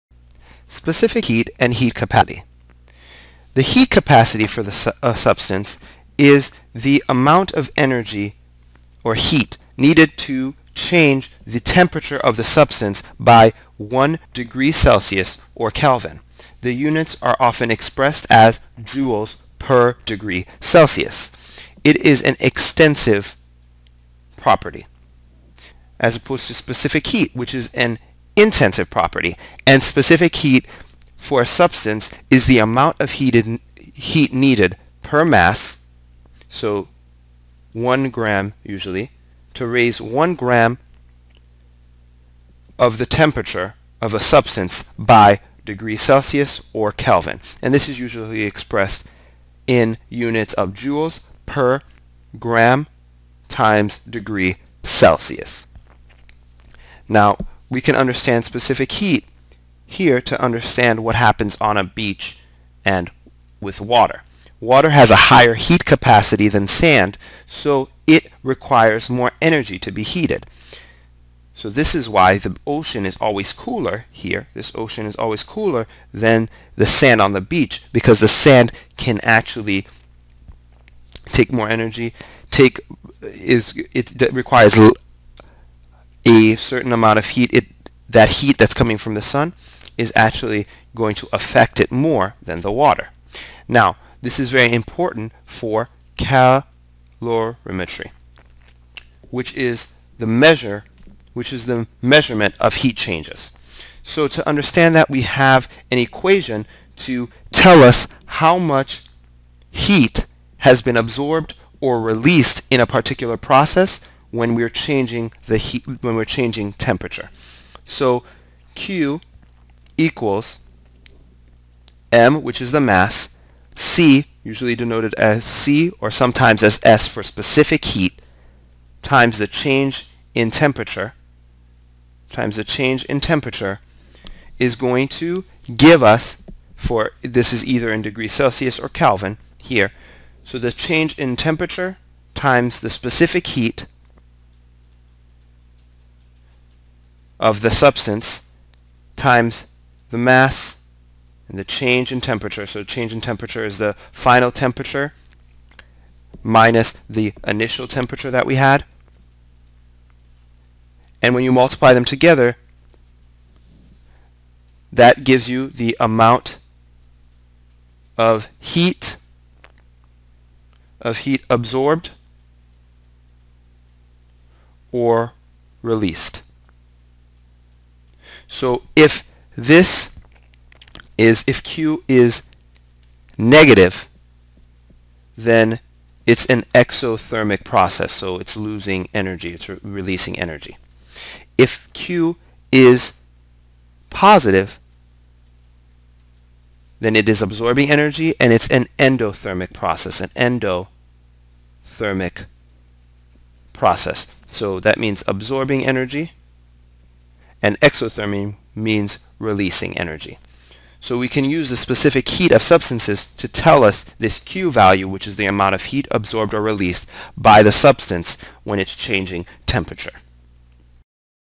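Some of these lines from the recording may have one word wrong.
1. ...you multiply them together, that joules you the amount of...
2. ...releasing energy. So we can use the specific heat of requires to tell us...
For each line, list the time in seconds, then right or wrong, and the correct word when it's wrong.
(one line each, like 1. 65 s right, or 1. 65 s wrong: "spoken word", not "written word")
1. 161 s wrong: "gives", not "joules"
2. 209 s wrong: "substances", not "requires".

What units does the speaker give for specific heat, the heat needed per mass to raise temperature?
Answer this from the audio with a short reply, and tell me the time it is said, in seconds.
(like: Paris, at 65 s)
joules per gram times degree Celsius, at 50 s.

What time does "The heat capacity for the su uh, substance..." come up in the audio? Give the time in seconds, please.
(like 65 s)
3 s.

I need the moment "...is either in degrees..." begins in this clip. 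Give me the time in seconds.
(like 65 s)
137 s.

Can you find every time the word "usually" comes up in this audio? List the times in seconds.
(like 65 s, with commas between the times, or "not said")
38 s, 47 s, 124 s.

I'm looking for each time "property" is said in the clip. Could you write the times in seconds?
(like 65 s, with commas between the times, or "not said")
24 s, 28 s.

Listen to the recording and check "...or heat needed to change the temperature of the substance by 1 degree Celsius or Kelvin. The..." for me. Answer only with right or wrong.
right.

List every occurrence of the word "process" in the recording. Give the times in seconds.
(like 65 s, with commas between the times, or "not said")
113 s, 187 s, 199 s, 203 s.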